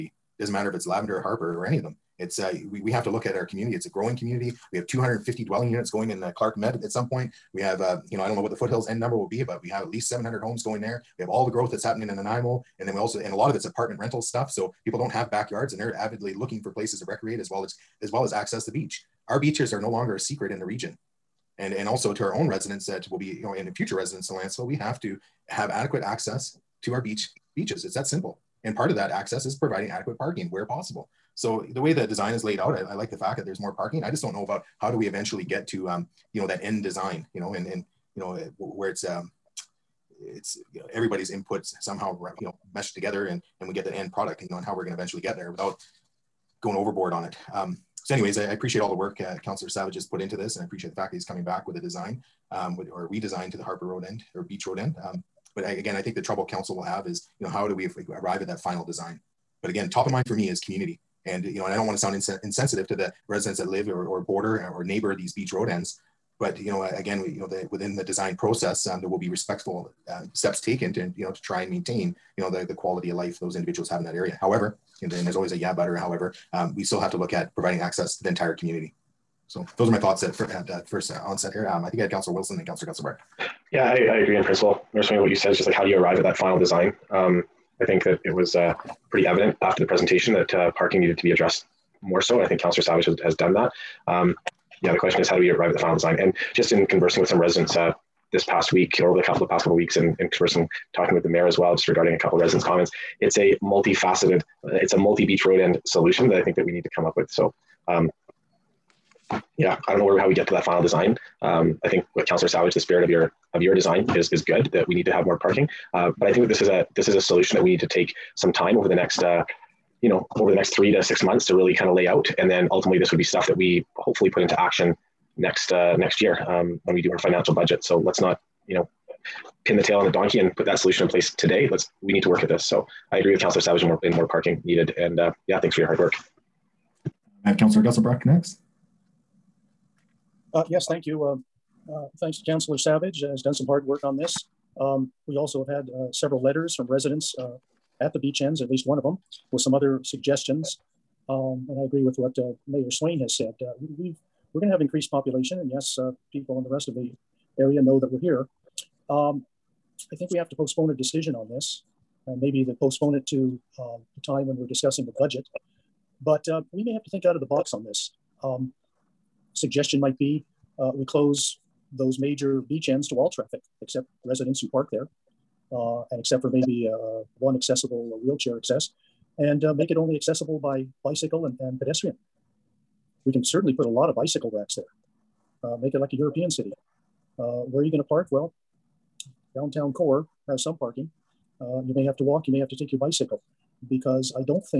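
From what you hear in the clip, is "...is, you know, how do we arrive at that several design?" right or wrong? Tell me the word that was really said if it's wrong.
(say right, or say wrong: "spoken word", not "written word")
wrong: "final", not "several".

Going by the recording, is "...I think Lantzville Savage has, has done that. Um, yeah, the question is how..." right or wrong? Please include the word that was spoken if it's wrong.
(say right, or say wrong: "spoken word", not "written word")
wrong: "Councillor", not "Lantzville".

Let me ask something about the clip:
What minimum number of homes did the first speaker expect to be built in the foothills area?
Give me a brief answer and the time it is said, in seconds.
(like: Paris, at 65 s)
700, at 10 s.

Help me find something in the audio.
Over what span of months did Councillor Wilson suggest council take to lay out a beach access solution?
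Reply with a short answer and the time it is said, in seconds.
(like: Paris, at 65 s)
three to six months, at 120 s.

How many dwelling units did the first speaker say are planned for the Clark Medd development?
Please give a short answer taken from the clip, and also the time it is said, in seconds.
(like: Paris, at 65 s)
250, at 4 s.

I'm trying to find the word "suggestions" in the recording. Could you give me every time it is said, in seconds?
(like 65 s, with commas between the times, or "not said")
150 s, 169 s.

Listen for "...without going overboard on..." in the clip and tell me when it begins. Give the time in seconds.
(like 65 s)
45 s.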